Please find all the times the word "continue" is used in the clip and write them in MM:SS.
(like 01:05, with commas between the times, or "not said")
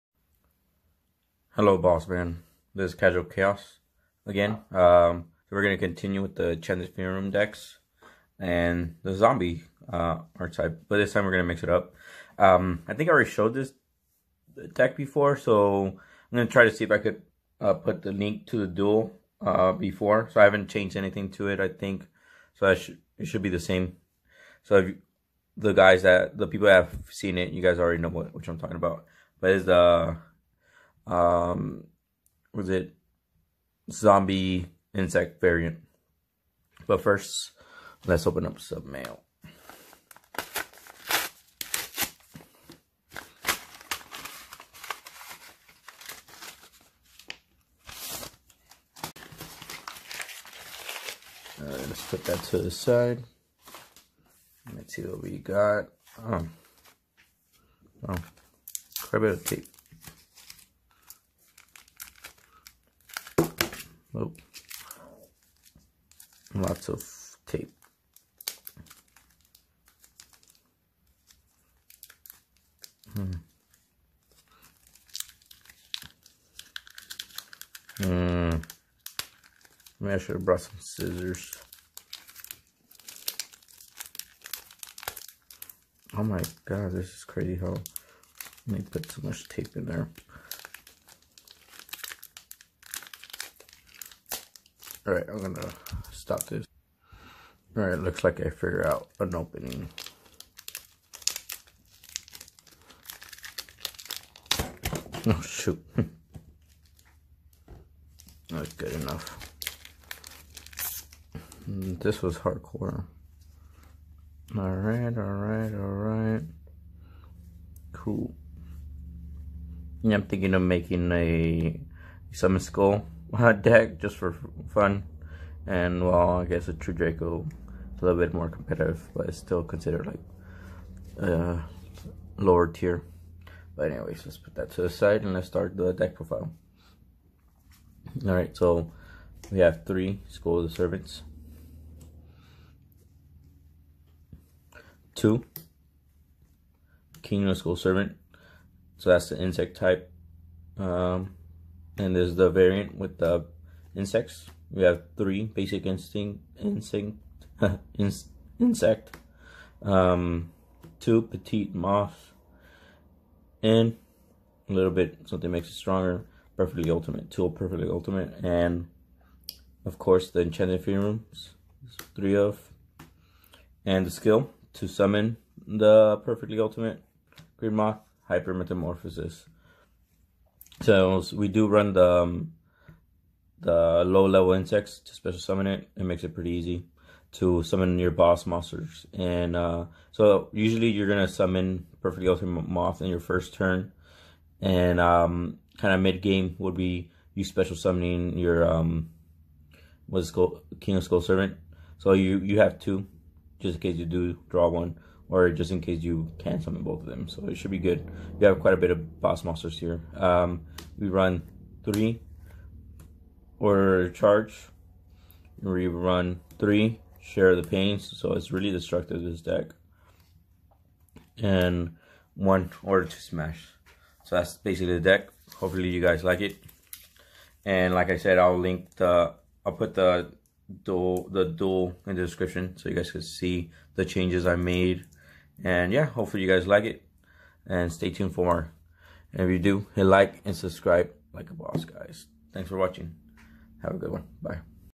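00:05.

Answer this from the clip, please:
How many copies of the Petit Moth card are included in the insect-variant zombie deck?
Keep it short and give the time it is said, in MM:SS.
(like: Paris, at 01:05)
2, at 02:40.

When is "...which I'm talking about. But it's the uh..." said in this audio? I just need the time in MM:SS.
00:28.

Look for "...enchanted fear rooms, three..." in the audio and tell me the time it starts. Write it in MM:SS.
02:50.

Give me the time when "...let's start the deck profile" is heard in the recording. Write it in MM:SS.
02:15.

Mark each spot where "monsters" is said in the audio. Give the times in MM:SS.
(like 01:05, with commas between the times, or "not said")
03:08, 03:29.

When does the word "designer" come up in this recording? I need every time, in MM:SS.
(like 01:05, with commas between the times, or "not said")
not said.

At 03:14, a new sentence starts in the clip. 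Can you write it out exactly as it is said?
And um, kind of mid game would be you special summoning your um, what's called King of Skull Servant.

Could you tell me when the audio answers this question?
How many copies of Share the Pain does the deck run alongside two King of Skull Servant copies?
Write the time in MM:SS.
03:36.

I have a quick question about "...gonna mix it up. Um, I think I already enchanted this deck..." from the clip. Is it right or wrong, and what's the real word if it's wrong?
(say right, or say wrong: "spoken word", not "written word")
wrong: "showed", not "enchanted".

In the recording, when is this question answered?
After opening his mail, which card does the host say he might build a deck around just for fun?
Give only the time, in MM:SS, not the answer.
02:02.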